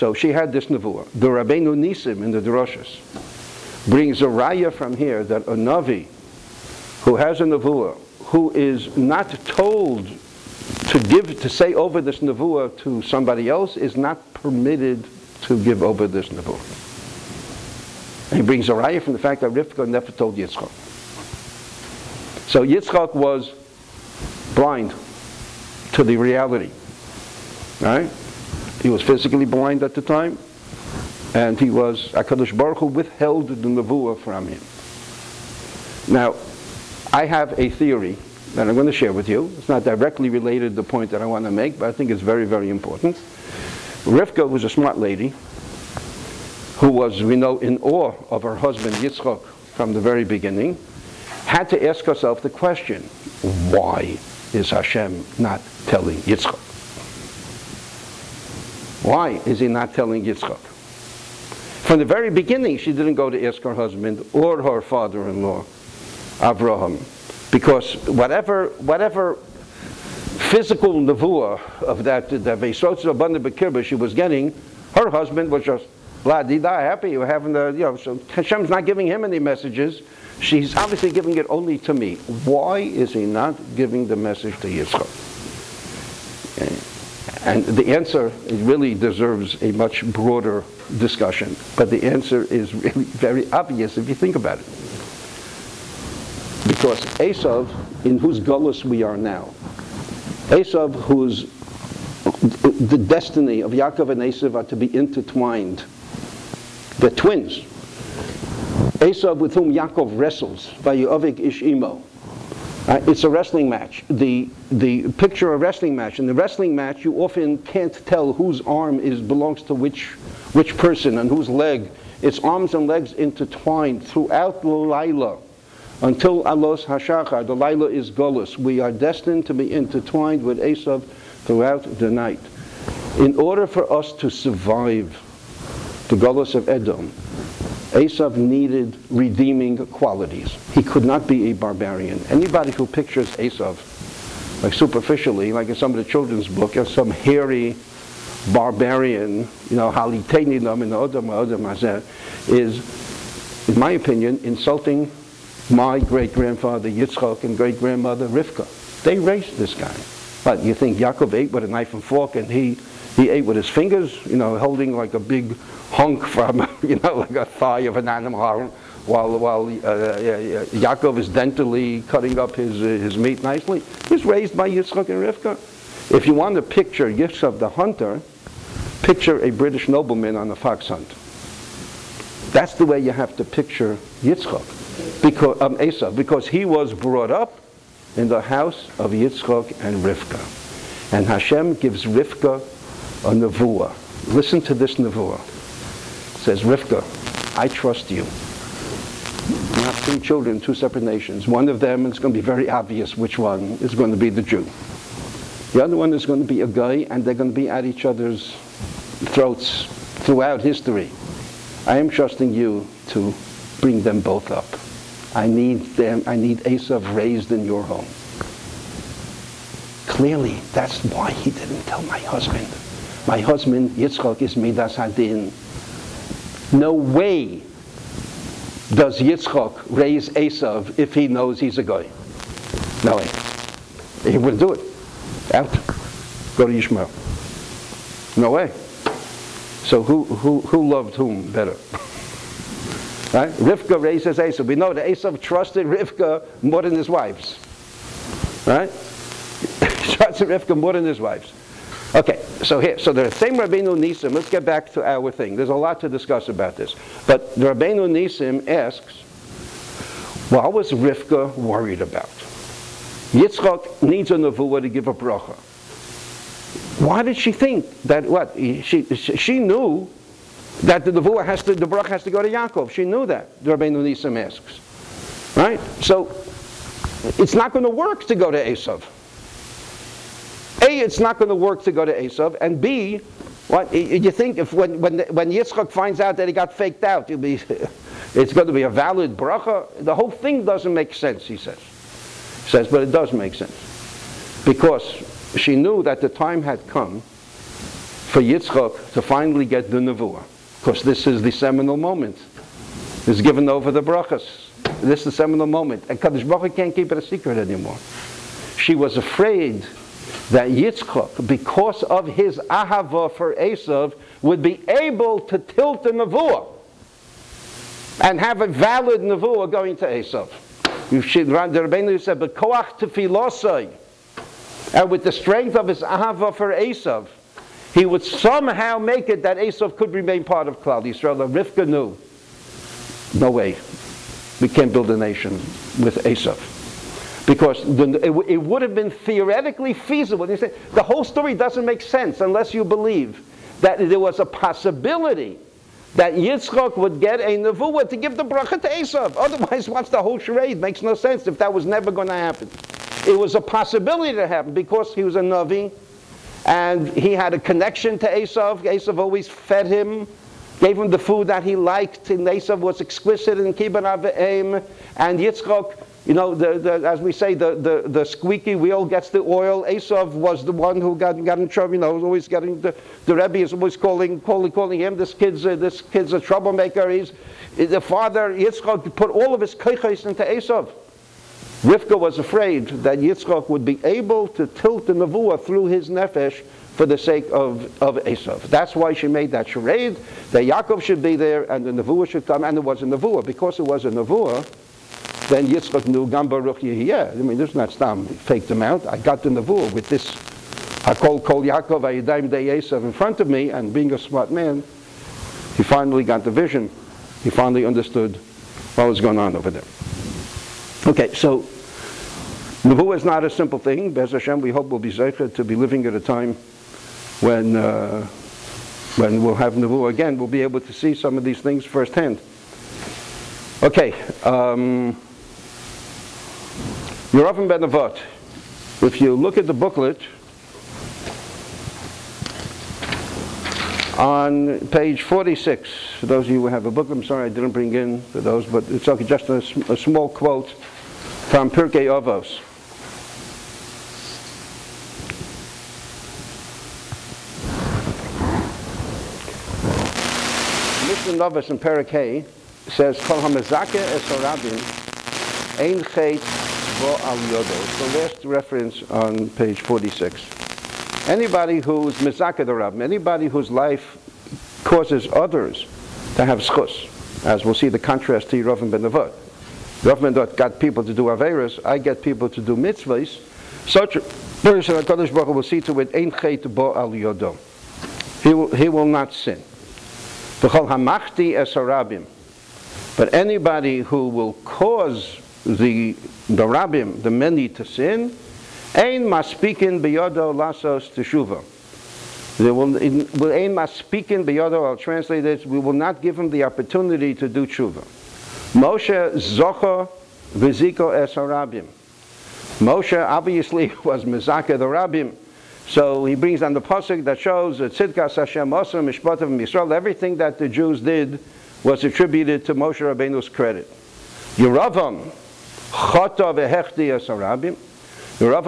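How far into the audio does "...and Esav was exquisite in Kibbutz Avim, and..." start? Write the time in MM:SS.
06:02.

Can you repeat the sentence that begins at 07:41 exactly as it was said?
Anybody who's mizakedarab, anybody whose life causes others to have zchus, as we'll see the contrast to Yerovim ben Nevot.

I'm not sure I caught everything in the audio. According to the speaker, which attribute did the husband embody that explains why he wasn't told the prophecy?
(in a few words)
Midas Hadin.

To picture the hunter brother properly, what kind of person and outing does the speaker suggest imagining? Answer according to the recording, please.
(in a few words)
British nobleman on a fox hunt.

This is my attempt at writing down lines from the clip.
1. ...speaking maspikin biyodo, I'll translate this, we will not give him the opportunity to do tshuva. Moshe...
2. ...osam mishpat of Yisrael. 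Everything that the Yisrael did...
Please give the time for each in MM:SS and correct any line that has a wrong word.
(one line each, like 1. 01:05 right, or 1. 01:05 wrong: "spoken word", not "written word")
1. 08:13 right
2. 08:28 wrong: "Jews", not "Yisrael".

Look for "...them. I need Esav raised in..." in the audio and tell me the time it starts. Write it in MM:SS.
03:35.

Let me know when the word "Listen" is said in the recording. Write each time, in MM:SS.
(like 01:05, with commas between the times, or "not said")
03:14.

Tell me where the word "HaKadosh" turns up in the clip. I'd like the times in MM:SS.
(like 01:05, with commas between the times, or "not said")
00:32, 07:54.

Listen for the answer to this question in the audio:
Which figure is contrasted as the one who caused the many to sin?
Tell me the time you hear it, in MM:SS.
07:07.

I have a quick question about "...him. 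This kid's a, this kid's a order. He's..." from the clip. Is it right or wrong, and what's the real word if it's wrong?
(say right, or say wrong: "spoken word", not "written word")
wrong: "troublemaker", not "order".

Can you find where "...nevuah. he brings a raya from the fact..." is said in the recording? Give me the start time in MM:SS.
00:16.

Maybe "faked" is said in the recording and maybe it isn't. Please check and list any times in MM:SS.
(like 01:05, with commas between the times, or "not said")
04:46, 06:38.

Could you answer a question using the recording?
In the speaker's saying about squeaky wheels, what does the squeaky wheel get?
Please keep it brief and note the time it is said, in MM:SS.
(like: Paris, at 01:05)
oil, at 06:09.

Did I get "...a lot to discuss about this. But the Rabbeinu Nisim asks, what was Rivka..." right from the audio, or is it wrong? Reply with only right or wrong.
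right.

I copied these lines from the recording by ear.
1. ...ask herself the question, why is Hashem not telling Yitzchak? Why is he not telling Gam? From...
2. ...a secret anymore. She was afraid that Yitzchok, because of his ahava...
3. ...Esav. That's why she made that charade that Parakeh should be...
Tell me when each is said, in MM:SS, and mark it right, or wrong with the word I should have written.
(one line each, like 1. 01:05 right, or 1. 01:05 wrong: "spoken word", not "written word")
1. 00:51 wrong: "Yitzchak", not "Gam"
2. 05:07 right
3. 06:28 wrong: "Yaakov", not "Parakeh".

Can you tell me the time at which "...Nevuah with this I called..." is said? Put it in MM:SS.
06:39.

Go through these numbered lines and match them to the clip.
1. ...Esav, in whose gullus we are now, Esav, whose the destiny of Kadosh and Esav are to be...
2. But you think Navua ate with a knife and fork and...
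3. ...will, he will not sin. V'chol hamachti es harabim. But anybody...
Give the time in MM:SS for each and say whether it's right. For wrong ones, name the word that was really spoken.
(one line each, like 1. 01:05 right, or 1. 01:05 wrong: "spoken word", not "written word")
1. 01:37 wrong: "Yaakov", not "Kadosh"
2. 02:40 wrong: "Yaakov", not "Navua"
3. 07:58 right.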